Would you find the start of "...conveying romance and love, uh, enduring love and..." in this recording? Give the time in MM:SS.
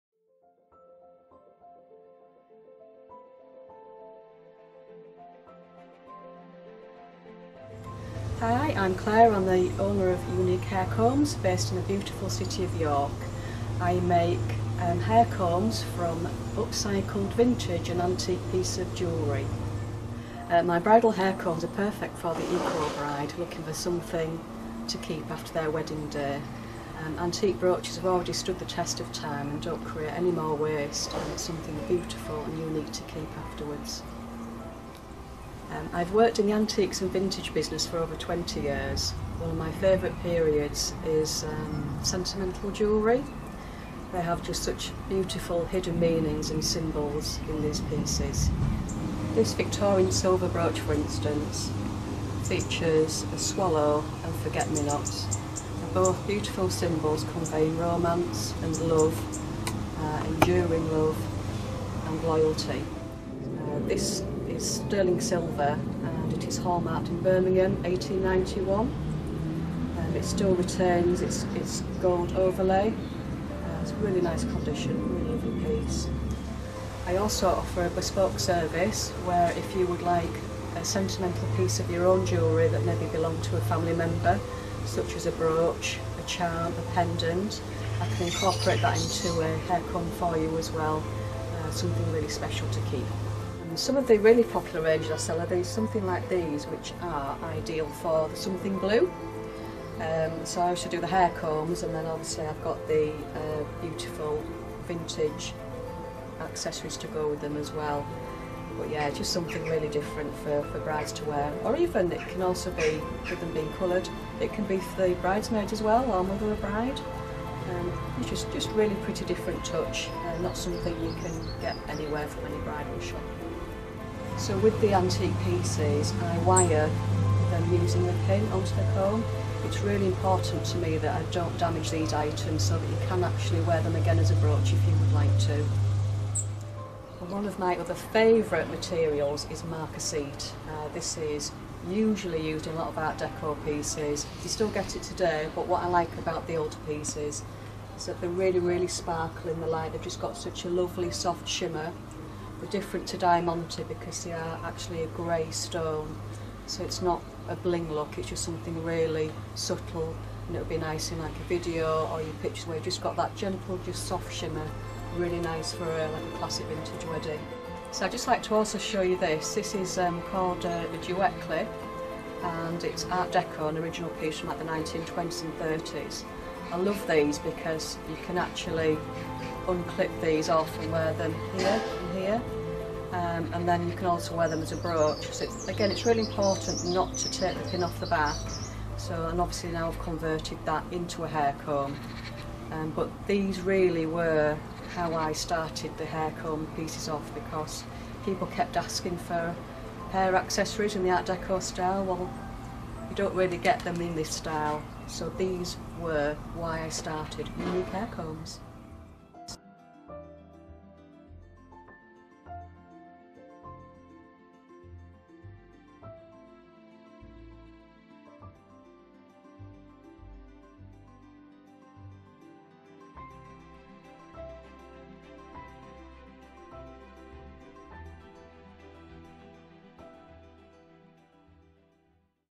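00:57.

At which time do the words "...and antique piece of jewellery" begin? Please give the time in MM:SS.
00:17.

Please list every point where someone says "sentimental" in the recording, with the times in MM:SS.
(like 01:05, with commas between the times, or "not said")
00:42, 01:20.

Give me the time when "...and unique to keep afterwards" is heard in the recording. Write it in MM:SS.
00:32.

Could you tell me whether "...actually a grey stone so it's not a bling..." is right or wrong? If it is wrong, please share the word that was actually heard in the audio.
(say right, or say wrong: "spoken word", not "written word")
right.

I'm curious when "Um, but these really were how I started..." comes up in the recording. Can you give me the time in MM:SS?
03:12.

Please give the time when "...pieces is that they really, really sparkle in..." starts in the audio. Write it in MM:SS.
02:26.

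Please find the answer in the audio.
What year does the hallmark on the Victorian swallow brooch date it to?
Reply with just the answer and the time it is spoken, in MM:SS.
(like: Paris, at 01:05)
1891, at 01:07.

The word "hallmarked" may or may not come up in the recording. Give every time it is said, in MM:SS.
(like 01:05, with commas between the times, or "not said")
01:06.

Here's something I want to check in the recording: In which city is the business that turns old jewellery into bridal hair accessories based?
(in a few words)
York.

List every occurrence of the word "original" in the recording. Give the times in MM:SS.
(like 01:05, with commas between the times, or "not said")
02:53.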